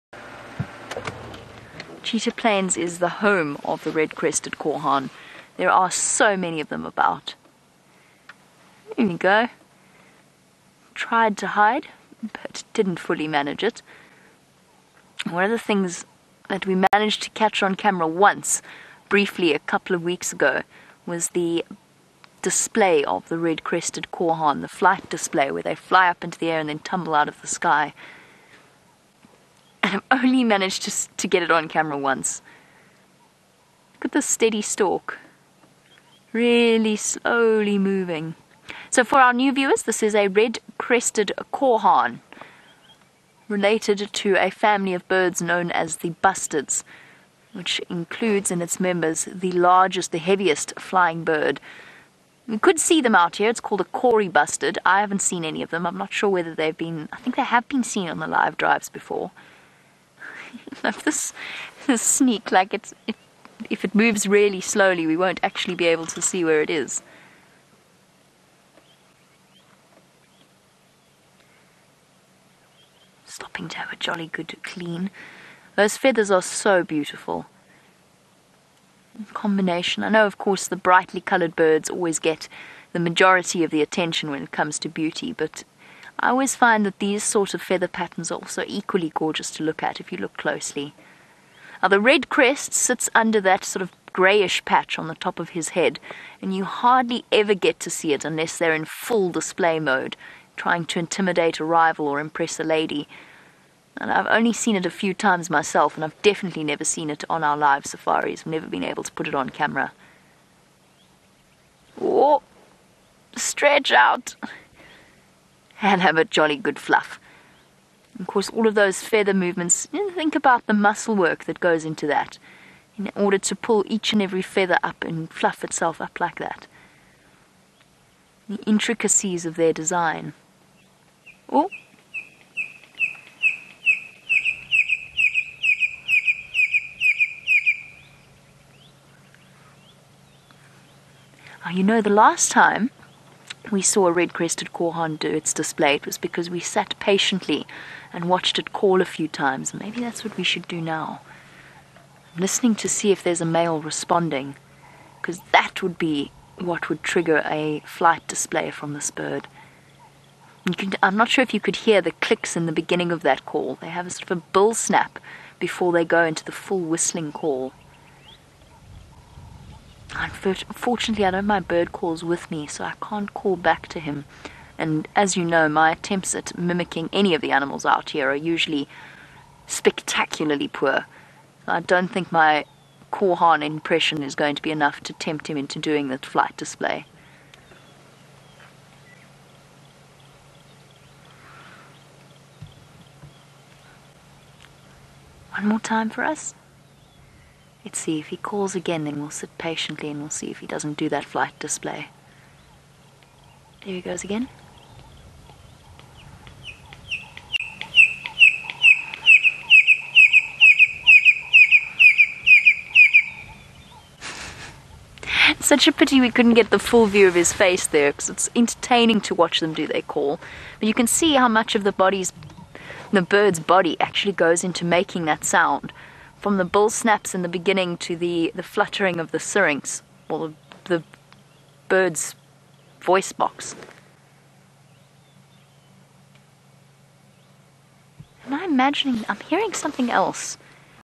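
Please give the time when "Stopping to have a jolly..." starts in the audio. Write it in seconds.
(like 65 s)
73 s.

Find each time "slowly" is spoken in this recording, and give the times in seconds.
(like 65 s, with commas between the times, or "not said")
36 s, 64 s.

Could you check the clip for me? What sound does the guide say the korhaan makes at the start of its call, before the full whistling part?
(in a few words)
bull snap.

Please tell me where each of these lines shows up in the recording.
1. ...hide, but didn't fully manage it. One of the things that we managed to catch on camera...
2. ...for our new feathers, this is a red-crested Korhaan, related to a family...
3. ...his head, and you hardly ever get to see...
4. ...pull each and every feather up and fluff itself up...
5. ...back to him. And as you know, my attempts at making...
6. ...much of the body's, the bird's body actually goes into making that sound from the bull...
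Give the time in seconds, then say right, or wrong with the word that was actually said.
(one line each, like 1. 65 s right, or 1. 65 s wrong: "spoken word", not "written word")
1. 11 s right
2. 39 s wrong: "viewers", not "feathers"
3. 95 s right
4. 123 s right
5. 173 s wrong: "mimicking", not "making"
6. 221 s right.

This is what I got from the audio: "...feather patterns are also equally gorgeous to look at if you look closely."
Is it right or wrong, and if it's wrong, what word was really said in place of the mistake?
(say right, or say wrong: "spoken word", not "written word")
right.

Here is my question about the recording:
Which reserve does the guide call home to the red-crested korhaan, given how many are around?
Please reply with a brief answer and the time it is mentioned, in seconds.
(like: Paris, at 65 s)
Cheetah Plains, at 2 s.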